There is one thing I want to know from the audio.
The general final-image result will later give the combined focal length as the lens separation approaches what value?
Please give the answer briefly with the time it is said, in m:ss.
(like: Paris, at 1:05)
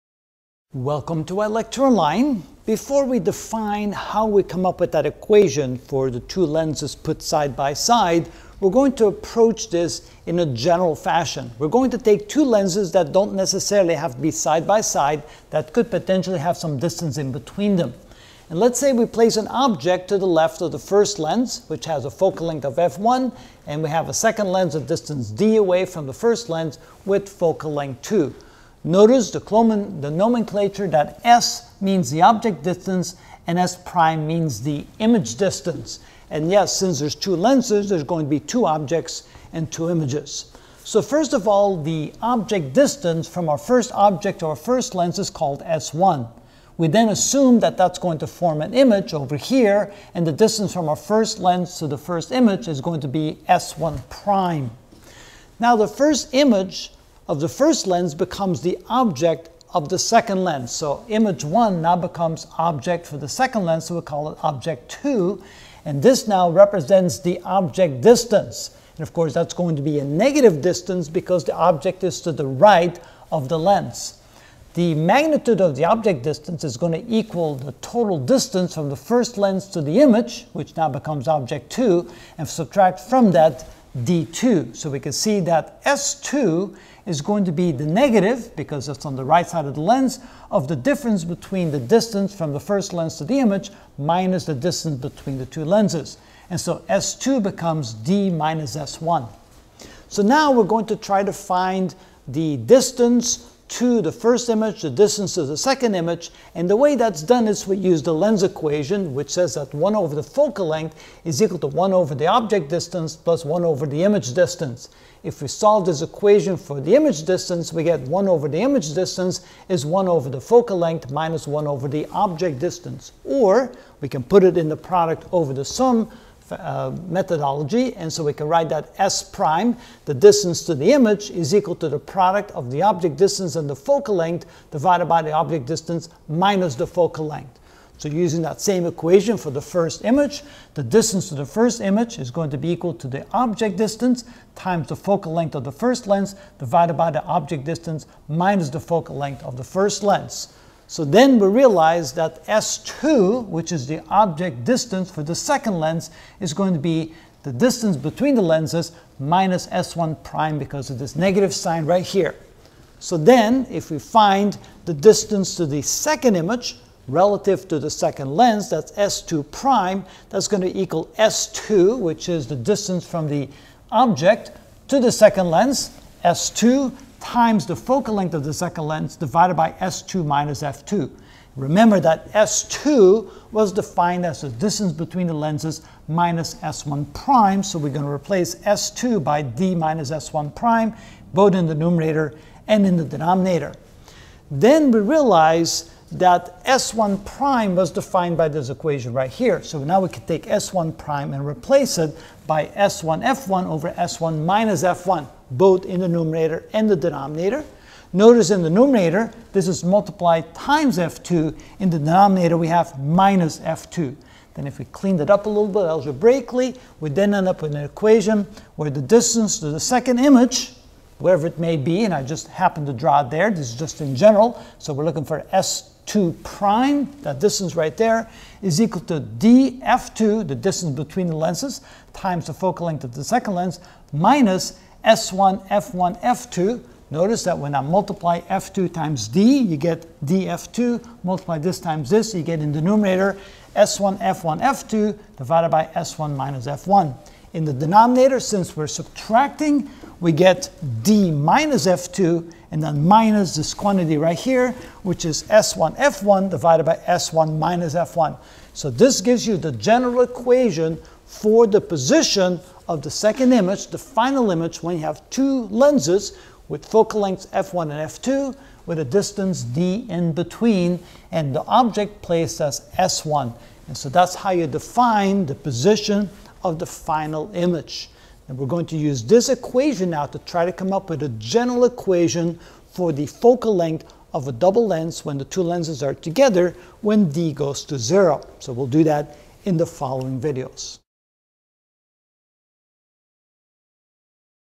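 0, at 4:47.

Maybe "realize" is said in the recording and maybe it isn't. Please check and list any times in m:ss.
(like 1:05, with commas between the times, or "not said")
2:31, 3:15.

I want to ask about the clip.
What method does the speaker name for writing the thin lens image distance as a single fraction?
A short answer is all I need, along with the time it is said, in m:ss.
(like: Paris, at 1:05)
Product over the sum, at 2:04.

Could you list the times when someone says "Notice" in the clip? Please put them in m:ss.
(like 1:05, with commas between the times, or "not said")
0:28, 3:28, 3:57.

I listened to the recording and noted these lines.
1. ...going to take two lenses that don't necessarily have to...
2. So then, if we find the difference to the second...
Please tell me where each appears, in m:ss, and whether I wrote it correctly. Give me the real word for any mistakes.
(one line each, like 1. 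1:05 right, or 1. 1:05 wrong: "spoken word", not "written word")
1. 0:11 right
2. 2:42 wrong: "distance", not "difference".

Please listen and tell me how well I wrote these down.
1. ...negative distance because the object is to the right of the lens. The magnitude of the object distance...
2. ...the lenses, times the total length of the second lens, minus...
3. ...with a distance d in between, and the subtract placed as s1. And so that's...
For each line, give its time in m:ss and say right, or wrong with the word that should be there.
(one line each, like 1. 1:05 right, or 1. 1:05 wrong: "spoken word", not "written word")
1. 1:10 right
2. 3:51 wrong: "focal", not "total"
3. 4:28 wrong: "object", not "subtract".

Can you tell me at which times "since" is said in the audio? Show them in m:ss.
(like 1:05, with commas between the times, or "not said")
0:36, 4:08.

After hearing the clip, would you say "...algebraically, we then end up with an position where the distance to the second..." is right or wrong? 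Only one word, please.
wrong.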